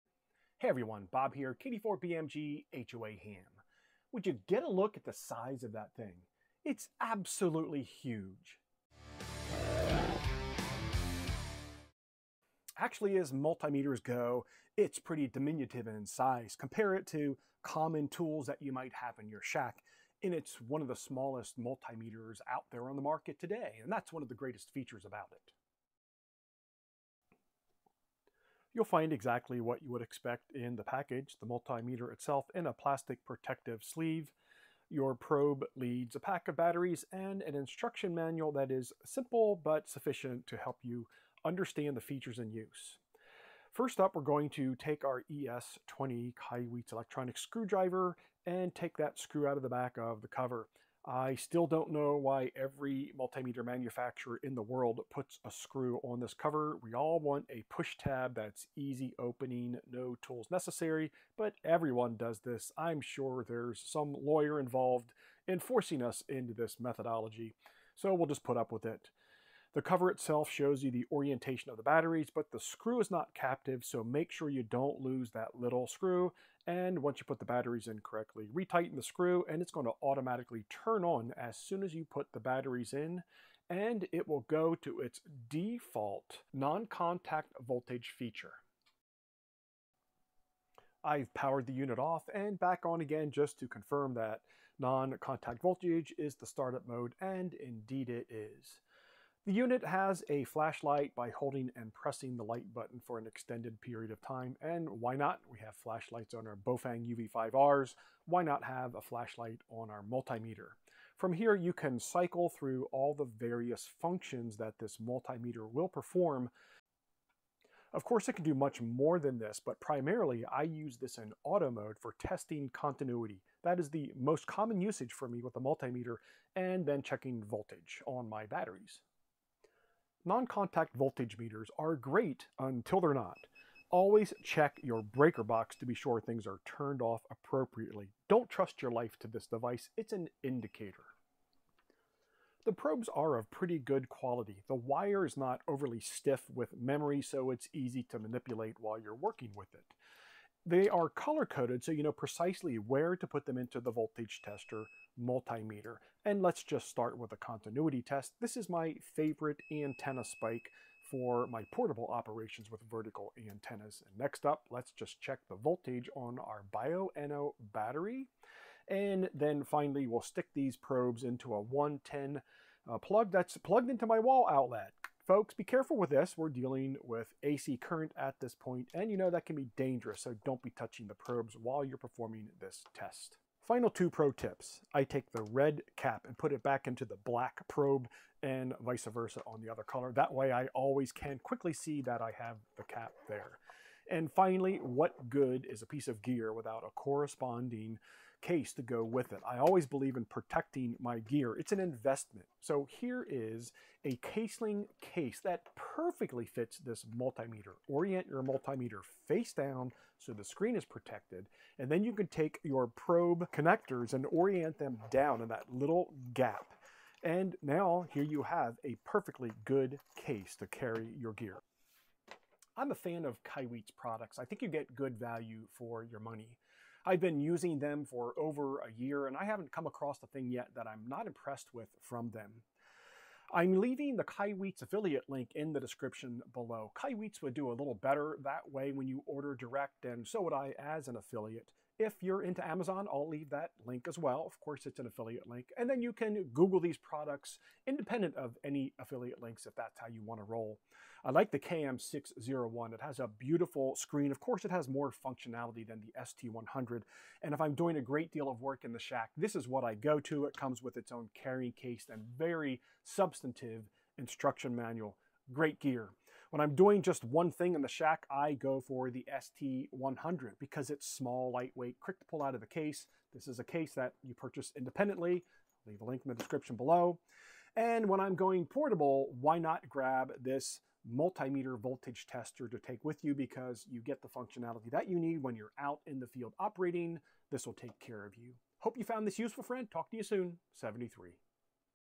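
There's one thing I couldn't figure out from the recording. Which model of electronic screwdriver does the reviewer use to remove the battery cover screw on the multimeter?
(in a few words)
ES20.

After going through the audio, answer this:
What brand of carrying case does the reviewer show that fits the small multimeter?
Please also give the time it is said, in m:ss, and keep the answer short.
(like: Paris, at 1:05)
Caseling, at 3:24.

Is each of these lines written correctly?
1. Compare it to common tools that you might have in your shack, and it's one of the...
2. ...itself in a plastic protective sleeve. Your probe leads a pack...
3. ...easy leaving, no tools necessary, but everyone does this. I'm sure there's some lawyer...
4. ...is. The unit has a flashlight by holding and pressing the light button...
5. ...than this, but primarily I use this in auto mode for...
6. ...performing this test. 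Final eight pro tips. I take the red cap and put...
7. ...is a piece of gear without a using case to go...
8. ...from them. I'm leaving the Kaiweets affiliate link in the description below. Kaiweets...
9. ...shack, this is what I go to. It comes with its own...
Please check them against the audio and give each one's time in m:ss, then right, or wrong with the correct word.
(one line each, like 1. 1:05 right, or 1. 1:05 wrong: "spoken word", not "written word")
1. 0:16 right
2. 0:32 right
3. 0:58 wrong: "opening", not "leaving"
4. 1:38 right
5. 1:59 right
6. 3:01 wrong: "two", not "eight"
7. 3:15 wrong: "corresponding", not "using"
8. 3:52 right
9. 4:18 right.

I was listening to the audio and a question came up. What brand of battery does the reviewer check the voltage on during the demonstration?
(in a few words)
Bioenno.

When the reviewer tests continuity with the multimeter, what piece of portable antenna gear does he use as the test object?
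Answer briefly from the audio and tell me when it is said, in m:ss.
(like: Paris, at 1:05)
antenna spike, at 2:39.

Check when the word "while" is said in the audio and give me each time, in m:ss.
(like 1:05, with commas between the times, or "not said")
2:28, 3:01.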